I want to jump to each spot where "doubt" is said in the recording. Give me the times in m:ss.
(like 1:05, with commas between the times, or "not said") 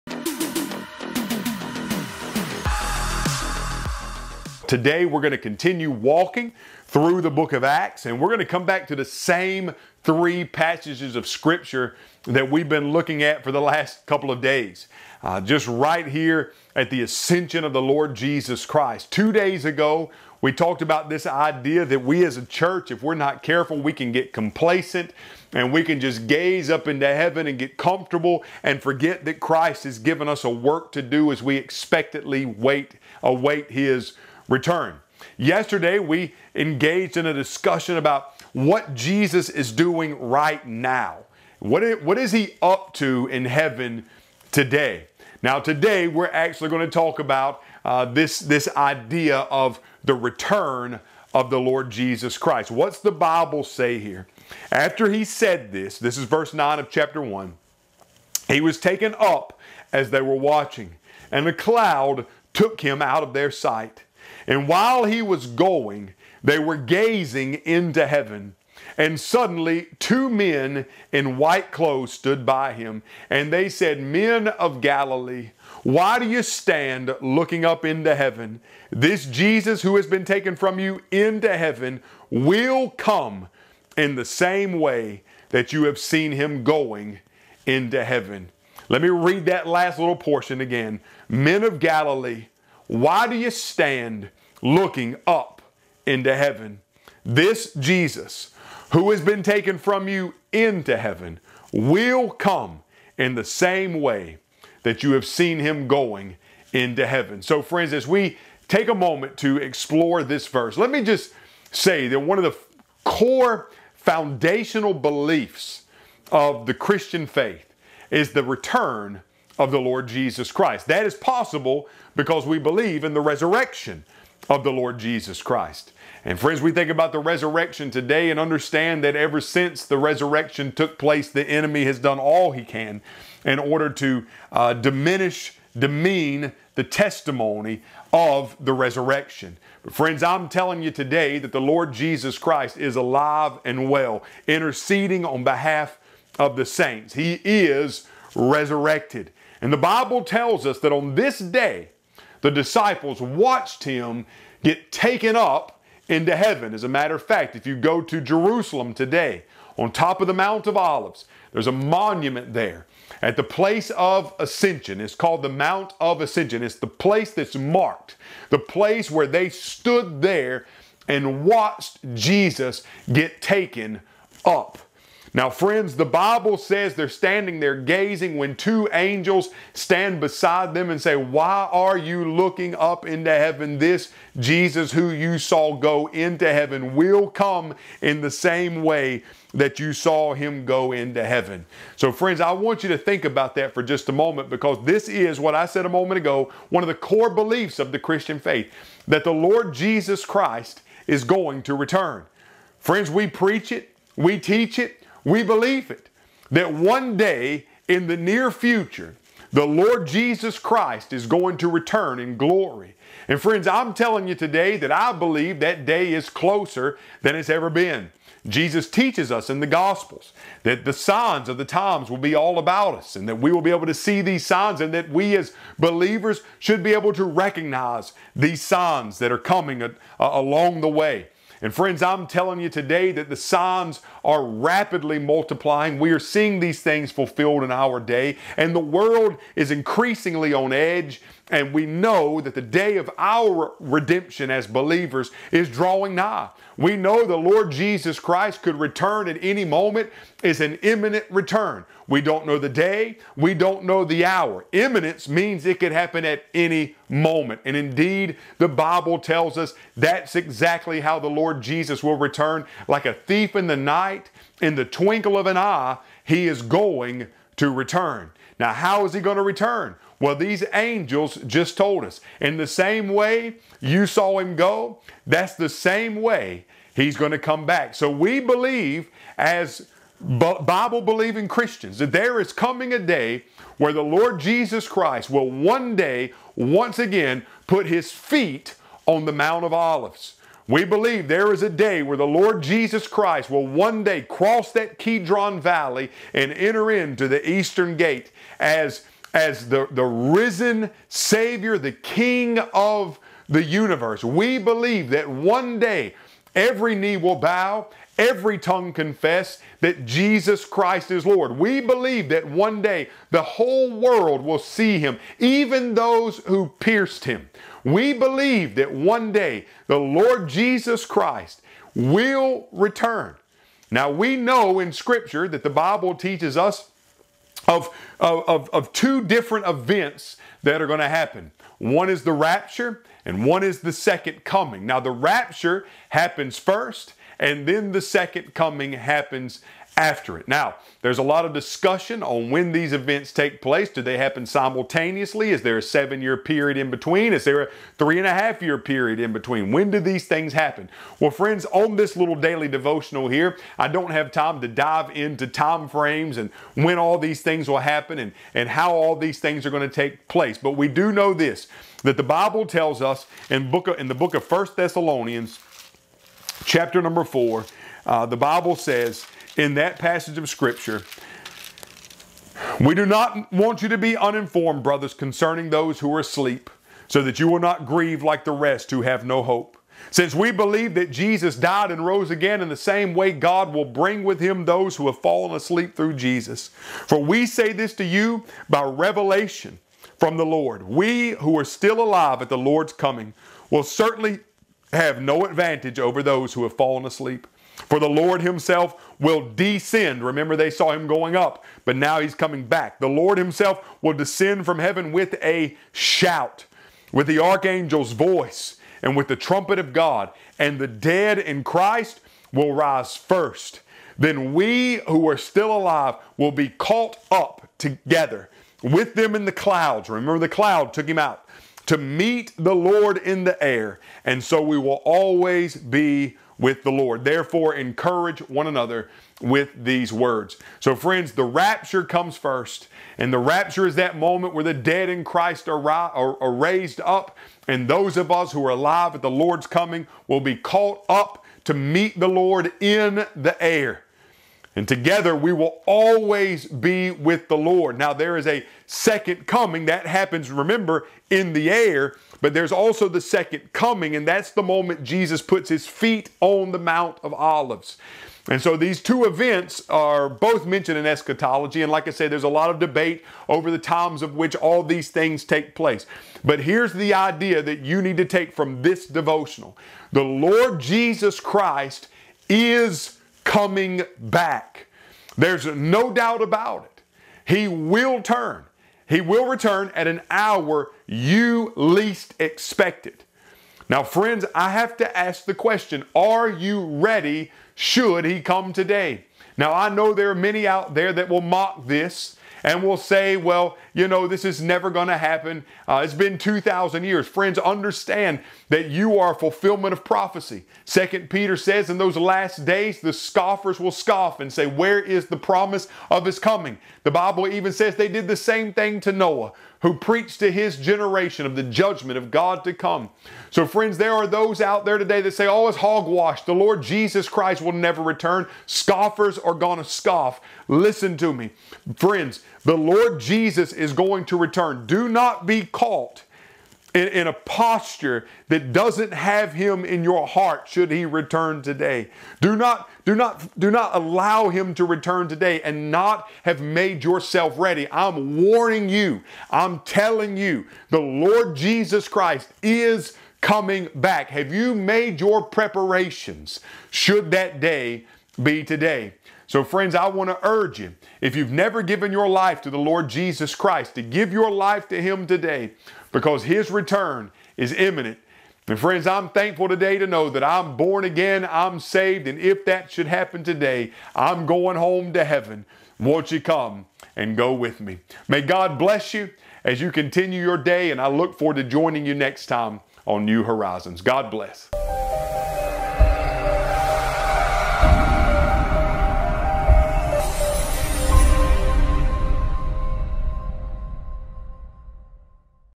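7:56.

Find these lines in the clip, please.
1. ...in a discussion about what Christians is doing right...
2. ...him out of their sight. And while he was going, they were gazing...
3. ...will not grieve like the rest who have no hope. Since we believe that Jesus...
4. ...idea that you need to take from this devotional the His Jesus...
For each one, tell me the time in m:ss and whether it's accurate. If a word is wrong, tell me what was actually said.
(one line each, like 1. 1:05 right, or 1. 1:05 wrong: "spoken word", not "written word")
1. 0:37 wrong: "Jesus", not "Christians"
2. 1:02 right
3. 6:17 right
4. 7:47 wrong: "Lord", not "His".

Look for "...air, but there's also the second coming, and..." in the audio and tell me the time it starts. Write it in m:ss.
7:31.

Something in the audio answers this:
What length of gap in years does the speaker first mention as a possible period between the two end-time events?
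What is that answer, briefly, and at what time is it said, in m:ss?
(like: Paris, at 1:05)
7, at 5:45.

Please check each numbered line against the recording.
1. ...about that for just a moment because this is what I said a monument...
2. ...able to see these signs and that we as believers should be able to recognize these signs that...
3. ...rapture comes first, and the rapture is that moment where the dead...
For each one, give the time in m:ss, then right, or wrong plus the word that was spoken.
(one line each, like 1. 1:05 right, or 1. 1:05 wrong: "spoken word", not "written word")
1. 3:13 wrong: "moment", not "monument"
2. 3:43 right
3. 7:11 right.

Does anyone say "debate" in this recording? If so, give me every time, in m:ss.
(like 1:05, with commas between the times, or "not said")
7:42.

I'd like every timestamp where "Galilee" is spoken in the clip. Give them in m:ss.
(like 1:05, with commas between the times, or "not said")
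1:14, 1:31.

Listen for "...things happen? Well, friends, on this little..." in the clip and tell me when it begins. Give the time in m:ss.
5:50.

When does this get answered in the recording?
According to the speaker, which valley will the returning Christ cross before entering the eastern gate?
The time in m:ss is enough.
4:54.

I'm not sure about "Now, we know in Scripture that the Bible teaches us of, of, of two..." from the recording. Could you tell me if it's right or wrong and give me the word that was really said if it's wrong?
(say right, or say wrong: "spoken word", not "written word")
right.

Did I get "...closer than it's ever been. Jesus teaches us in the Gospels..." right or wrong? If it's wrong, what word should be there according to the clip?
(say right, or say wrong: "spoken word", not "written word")
right.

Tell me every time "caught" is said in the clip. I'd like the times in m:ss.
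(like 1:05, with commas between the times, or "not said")
6:56, 7:20, 8:45.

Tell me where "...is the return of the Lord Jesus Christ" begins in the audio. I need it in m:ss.
1:58.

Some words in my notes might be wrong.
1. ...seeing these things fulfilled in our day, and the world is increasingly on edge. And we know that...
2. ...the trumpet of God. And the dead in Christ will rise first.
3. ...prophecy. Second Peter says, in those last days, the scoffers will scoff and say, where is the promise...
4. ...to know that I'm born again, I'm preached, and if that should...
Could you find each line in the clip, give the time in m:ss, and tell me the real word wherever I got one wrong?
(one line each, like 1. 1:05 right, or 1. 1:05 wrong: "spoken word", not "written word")
1. 3:56 right
2. 6:49 right
3. 8:20 right
4. 9:19 wrong: "saved", not "preached".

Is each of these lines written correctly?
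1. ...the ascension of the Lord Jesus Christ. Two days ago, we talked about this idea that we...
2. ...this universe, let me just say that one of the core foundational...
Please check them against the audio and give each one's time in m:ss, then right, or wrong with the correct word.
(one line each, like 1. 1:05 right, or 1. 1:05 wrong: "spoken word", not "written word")
1. 0:16 right
2. 1:50 wrong: "verse", not "universe".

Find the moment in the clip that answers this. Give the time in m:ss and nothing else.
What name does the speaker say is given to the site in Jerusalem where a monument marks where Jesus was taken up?
2:45.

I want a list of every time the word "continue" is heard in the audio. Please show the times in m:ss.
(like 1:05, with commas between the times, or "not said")
0:05, 9:29.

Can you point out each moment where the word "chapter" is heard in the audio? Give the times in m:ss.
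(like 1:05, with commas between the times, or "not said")
0:56, 6:06.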